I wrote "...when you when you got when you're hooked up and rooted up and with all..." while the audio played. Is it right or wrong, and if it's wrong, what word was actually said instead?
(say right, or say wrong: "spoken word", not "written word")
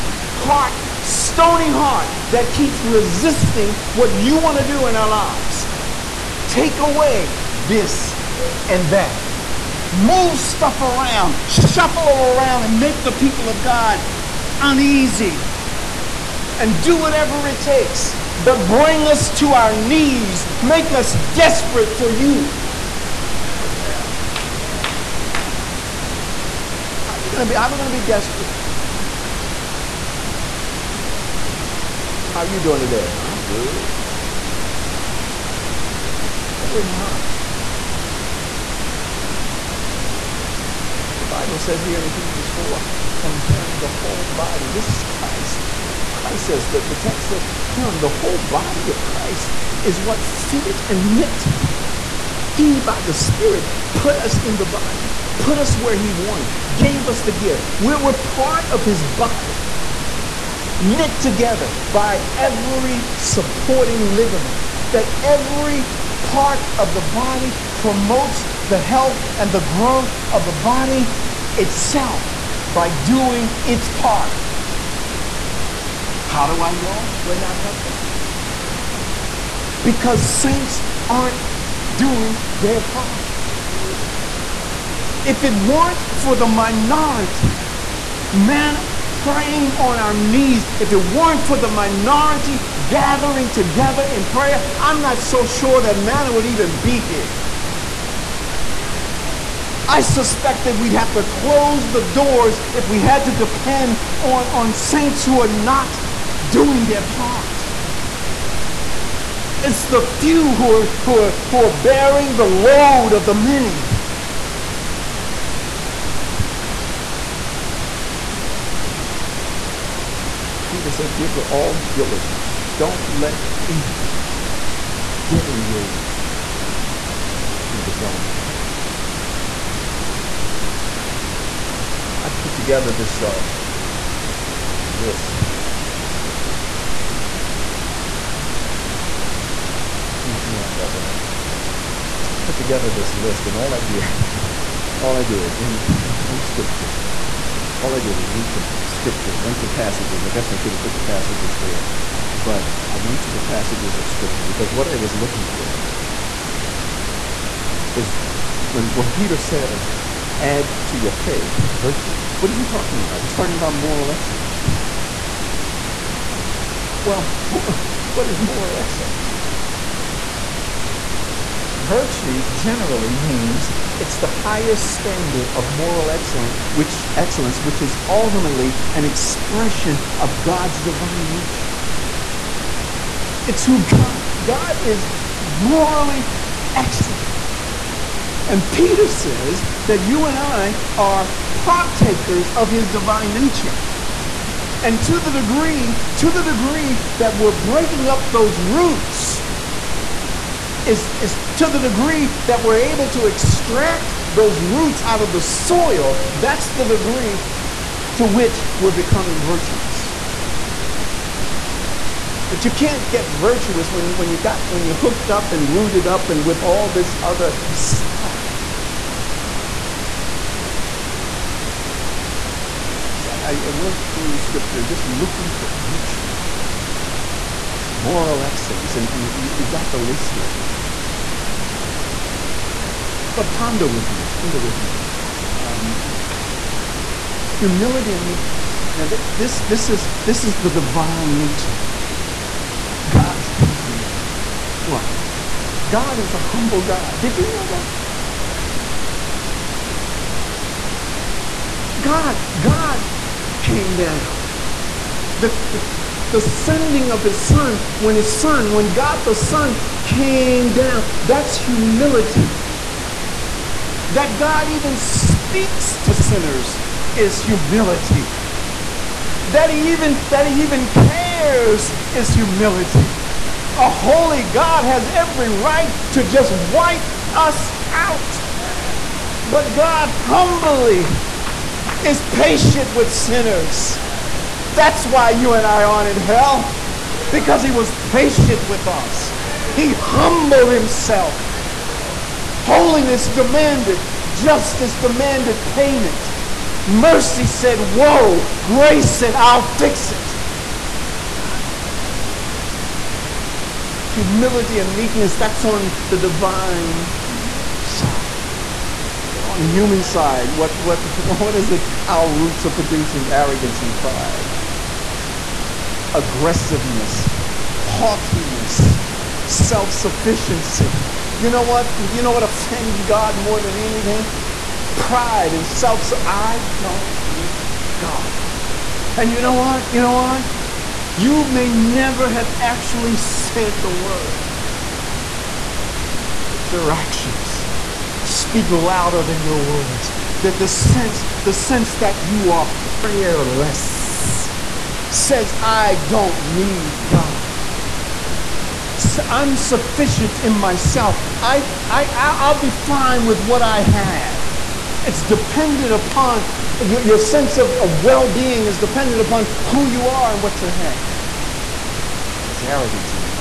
right.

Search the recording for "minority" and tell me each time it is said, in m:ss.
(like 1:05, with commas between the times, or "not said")
1:26, 1:31.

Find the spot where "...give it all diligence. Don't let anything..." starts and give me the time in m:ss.
2:01.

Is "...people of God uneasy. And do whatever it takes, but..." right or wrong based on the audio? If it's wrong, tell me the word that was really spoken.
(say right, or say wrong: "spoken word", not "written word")
right.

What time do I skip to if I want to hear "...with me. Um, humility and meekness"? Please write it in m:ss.
3:54.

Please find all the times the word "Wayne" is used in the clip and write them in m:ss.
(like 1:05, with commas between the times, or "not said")
not said.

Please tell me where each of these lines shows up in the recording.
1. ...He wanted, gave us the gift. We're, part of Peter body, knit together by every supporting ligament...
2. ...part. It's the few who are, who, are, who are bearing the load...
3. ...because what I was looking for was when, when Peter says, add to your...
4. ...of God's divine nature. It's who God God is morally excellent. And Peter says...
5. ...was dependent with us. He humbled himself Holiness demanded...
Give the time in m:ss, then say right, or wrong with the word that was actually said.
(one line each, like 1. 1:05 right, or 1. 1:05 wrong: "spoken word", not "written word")
1. 0:55 wrong: "His", not "Peter"
2. 1:47 right
3. 2:34 right
4. 3:00 right
5. 4:47 wrong: "patient", not "dependent".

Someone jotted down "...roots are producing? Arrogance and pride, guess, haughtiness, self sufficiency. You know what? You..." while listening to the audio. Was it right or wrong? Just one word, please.
wrong.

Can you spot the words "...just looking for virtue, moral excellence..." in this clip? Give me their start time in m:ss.
3:44.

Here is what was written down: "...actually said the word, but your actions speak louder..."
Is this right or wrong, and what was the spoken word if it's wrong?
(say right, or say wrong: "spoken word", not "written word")
right.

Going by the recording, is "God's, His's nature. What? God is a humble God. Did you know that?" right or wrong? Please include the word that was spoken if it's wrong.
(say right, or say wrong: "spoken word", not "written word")
wrong: "God", not "His".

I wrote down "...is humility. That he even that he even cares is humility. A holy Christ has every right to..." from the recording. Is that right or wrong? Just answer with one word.
wrong.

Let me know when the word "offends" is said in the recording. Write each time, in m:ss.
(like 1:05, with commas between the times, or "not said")
5:22.